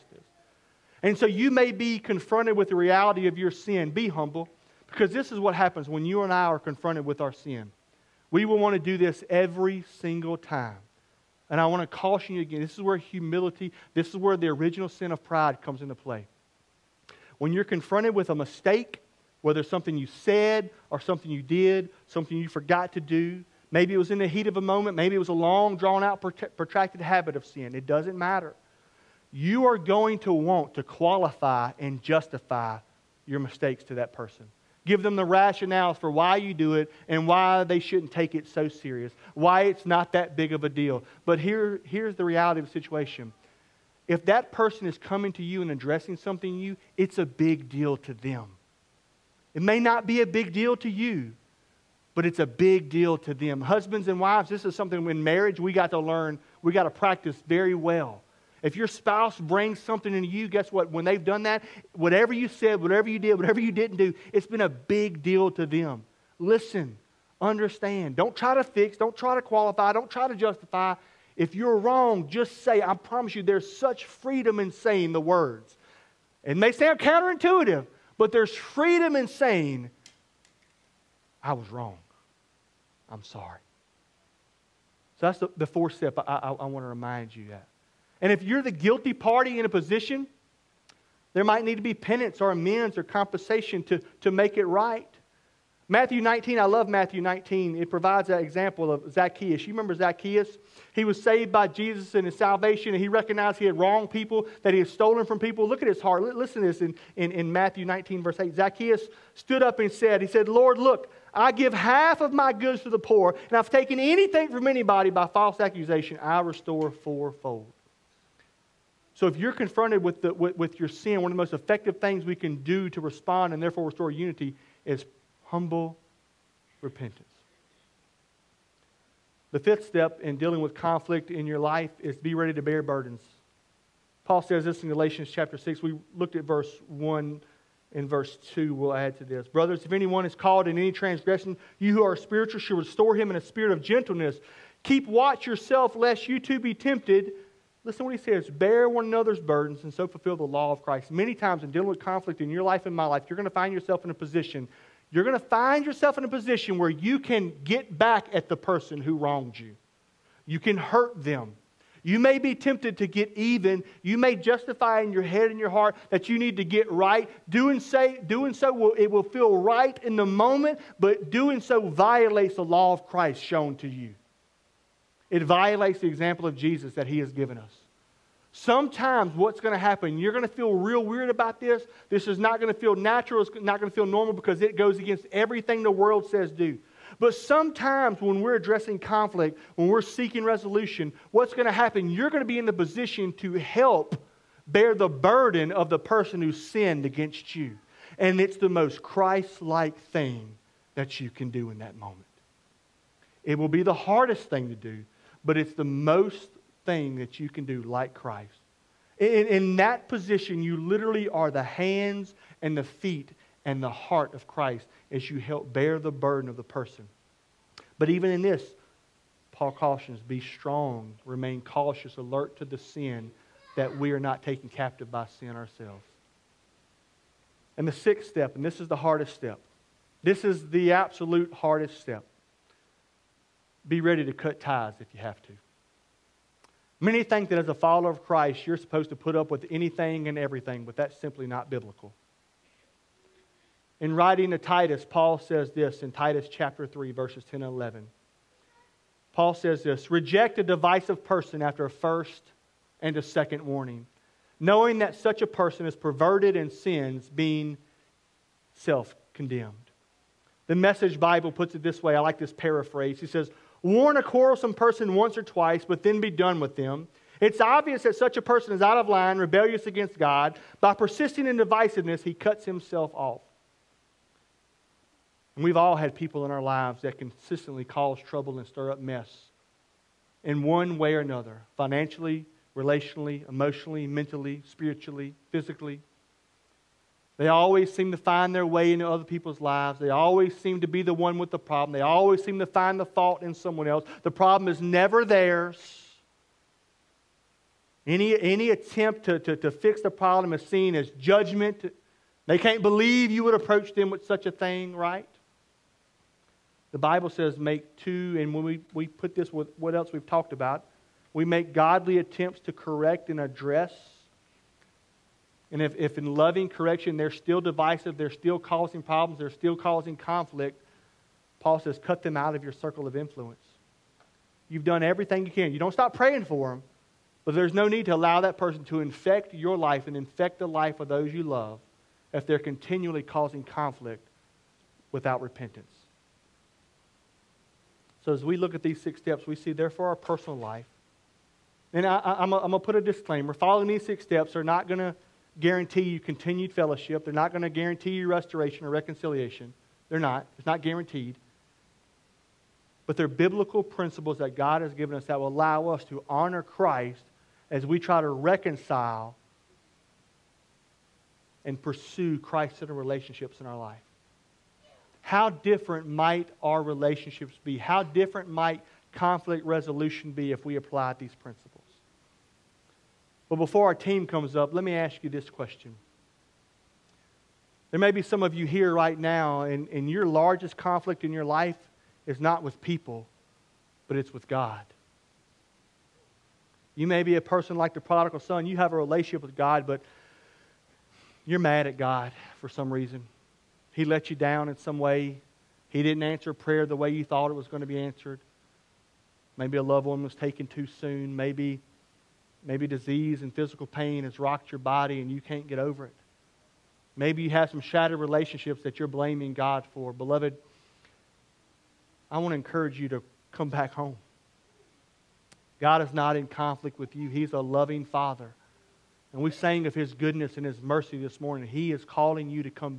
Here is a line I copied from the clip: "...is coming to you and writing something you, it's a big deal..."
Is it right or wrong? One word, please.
wrong.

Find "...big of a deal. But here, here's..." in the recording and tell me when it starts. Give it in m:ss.
0:40.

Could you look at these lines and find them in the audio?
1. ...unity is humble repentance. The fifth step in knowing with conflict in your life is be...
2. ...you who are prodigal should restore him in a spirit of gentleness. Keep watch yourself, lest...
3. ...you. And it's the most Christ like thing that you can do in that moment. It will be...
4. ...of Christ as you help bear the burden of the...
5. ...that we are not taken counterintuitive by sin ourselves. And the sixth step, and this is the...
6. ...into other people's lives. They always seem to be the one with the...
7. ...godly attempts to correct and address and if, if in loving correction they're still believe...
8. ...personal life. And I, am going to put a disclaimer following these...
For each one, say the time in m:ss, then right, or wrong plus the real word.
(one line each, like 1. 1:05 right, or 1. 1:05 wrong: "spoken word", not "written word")
1. 2:04 wrong: "dealing", not "knowing"
2. 2:21 wrong: "spiritual", not "prodigal"
3. 3:17 right
4. 3:34 right
5. 3:43 wrong: "captive", not "counterintuitive"
6. 4:48 right
7. 5:11 wrong: "divisive", not "believe"
8. 5:40 right.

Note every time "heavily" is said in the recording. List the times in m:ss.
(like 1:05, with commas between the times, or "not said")
not said.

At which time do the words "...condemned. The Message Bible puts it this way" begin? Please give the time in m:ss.
4:19.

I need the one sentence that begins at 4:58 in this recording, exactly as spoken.
Any, any attempt to, to, to fix the problem is seen as judgment.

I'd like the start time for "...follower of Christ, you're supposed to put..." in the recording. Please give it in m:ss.
3:57.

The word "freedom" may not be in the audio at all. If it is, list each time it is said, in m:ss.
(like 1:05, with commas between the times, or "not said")
1:14, 1:18.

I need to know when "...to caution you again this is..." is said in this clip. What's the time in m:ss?
0:11.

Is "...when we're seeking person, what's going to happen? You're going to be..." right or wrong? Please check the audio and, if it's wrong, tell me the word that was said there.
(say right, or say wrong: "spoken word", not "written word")
wrong: "resolution", not "person".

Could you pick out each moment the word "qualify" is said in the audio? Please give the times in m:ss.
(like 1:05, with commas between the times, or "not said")
0:30, 1:09.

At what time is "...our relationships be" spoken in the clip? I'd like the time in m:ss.
6:06.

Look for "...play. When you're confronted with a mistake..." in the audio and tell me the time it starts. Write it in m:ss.
0:15.